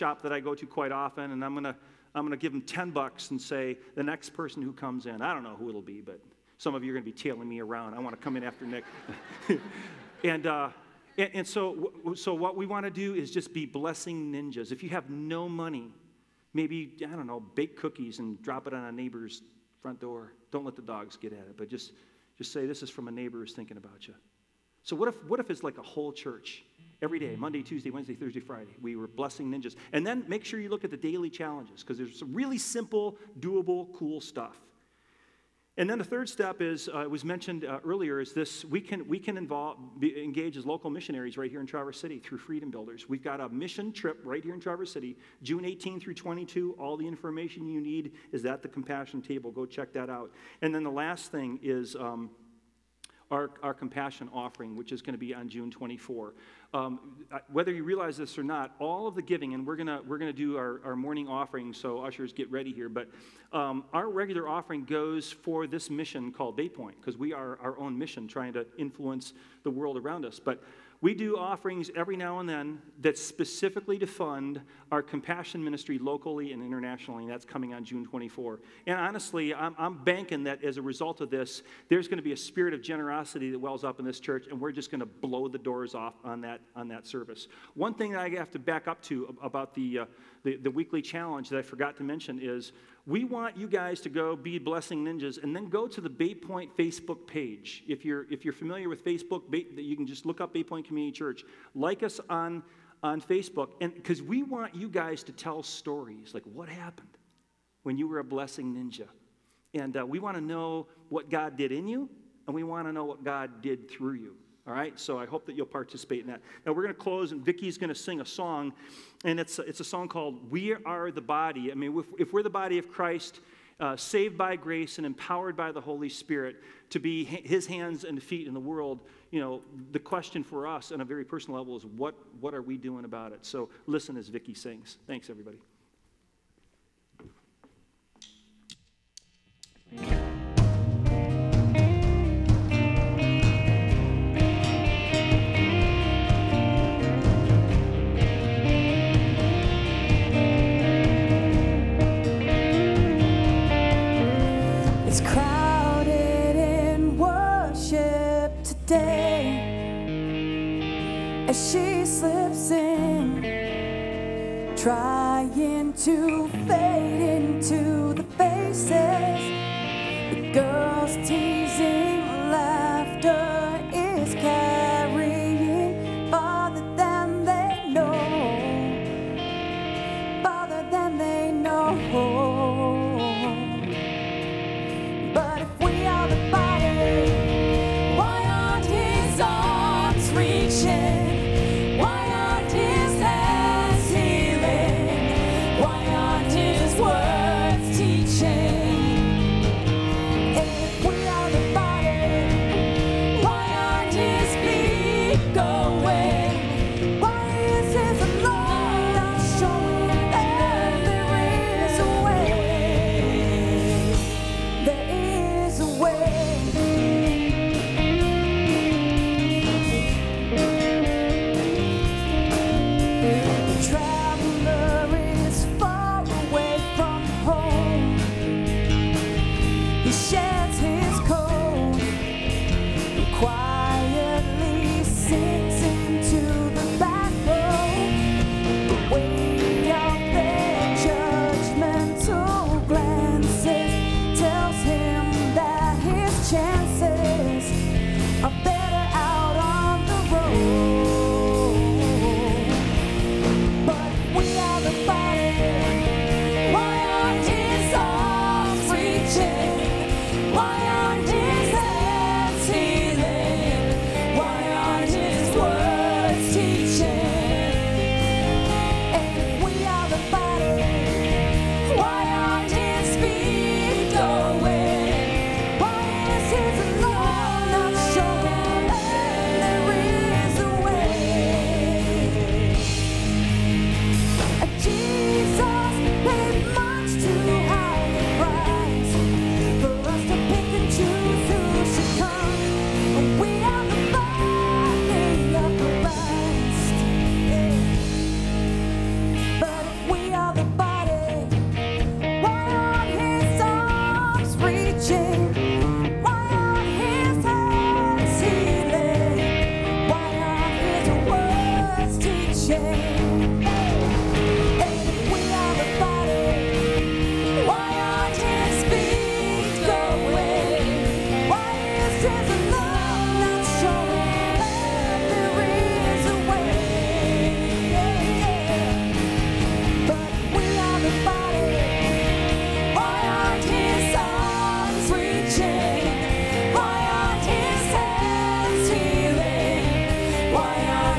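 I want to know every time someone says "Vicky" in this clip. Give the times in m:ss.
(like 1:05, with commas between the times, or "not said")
1:57, 2:14.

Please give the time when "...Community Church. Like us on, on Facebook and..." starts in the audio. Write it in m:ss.
1:40.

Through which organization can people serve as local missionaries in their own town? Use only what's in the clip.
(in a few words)
Freedom Builders.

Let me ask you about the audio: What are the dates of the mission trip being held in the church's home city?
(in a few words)
June 18 through 22.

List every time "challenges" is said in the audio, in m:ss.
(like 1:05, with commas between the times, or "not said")
0:31, 1:31.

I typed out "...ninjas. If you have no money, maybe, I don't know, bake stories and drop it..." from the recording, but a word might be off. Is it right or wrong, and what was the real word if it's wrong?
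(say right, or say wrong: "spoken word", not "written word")
wrong: "cookies", not "stories".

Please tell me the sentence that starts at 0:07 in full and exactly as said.
I want to come in after Nick.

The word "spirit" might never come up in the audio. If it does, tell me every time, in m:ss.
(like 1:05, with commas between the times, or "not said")
1:22, 2:06.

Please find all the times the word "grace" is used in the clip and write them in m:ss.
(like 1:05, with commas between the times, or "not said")
2:04.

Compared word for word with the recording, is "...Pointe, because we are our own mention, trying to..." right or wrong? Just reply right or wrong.
wrong.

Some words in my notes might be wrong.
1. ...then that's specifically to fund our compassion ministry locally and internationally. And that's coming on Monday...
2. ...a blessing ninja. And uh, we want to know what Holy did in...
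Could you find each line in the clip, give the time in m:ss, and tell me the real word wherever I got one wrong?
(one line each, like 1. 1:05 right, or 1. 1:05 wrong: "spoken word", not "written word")
1. 1:12 wrong: "June", not "Monday"
2. 1:48 wrong: "God", not "Holy".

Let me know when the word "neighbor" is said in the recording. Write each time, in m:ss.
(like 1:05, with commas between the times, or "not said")
0:18, 0:23.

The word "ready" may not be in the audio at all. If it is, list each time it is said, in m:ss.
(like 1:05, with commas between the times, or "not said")
1:02.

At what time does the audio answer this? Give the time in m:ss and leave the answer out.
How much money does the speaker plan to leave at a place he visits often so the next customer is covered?
0:02.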